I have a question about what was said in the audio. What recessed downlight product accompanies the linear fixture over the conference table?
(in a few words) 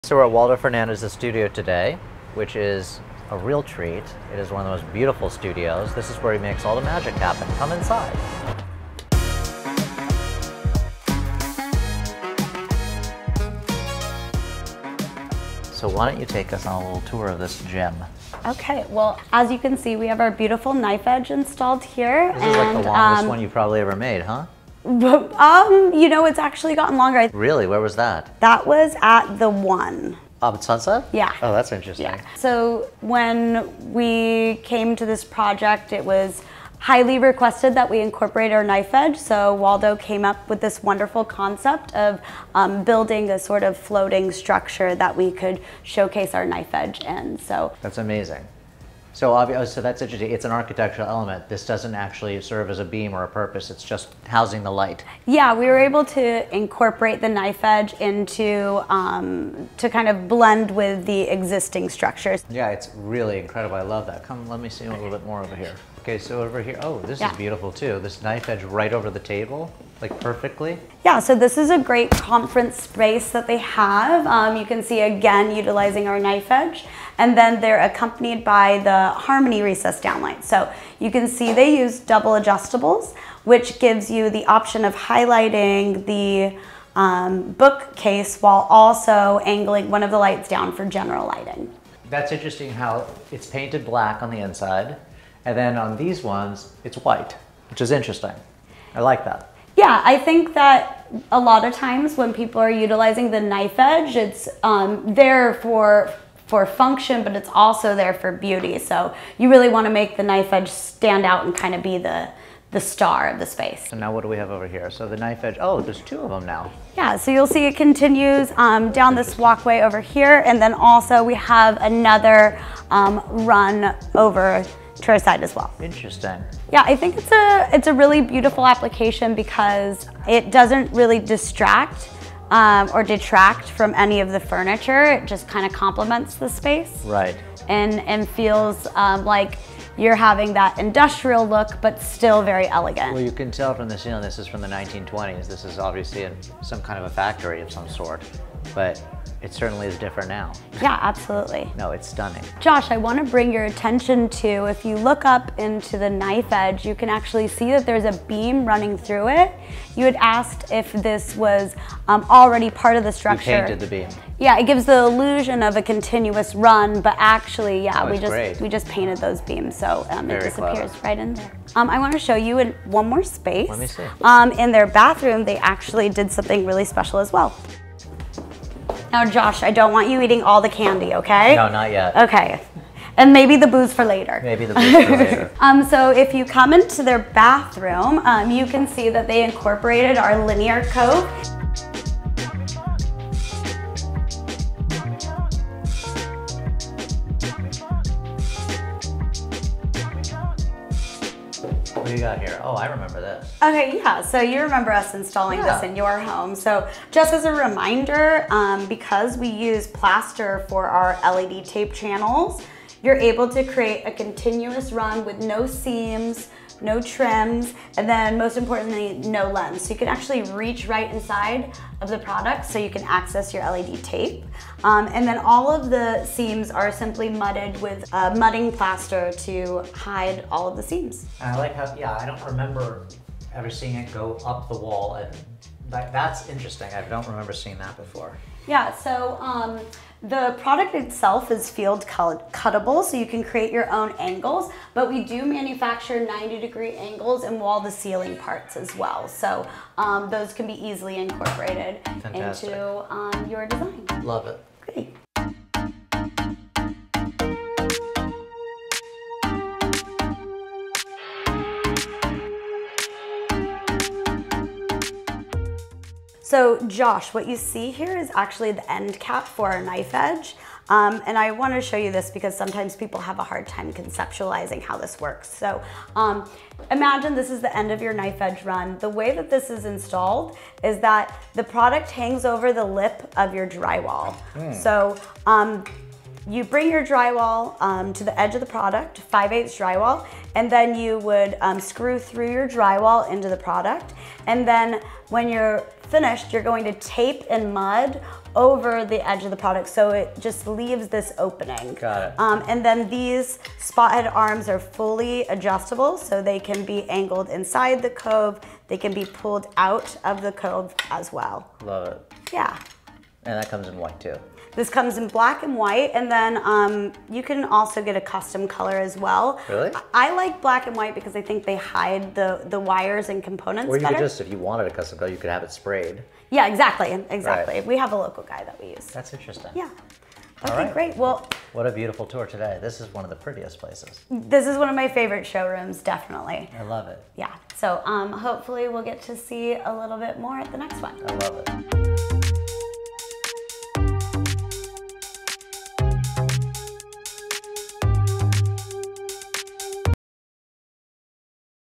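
Harmony.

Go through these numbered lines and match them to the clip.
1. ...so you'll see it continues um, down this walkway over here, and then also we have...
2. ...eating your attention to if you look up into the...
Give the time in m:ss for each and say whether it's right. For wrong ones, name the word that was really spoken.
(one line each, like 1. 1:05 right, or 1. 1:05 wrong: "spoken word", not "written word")
1. 1:57 right
2. 2:33 wrong: "bring", not "eating".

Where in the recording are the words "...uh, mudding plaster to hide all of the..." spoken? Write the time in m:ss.
3:48.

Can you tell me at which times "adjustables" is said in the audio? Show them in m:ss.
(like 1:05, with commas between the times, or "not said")
1:22, 5:05.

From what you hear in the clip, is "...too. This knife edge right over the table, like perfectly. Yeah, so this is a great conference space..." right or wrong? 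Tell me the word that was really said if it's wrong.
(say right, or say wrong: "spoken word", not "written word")
right.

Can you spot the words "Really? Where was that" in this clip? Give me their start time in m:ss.
0:27.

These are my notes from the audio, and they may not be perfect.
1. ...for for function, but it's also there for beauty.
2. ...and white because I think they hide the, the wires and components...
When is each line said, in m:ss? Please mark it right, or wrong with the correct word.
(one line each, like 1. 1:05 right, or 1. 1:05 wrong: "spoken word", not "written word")
1. 1:45 right
2. 5:20 right.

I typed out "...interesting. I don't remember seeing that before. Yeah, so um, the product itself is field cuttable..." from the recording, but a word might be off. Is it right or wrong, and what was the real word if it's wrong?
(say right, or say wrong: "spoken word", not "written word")
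right.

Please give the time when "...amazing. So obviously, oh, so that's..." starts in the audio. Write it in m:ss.
0:47.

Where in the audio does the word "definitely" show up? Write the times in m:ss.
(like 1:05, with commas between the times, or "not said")
5:36.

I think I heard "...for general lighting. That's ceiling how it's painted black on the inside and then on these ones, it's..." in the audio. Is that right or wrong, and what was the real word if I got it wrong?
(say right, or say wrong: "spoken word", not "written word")
wrong: "interesting", not "ceiling".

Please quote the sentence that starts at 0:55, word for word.
Yeah, we were able to incorporate the knife edge into um, to kind of blend with the existing structures.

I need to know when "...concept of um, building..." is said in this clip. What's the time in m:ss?
0:41.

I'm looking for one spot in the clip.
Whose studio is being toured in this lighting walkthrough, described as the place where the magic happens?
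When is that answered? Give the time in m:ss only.
0:00.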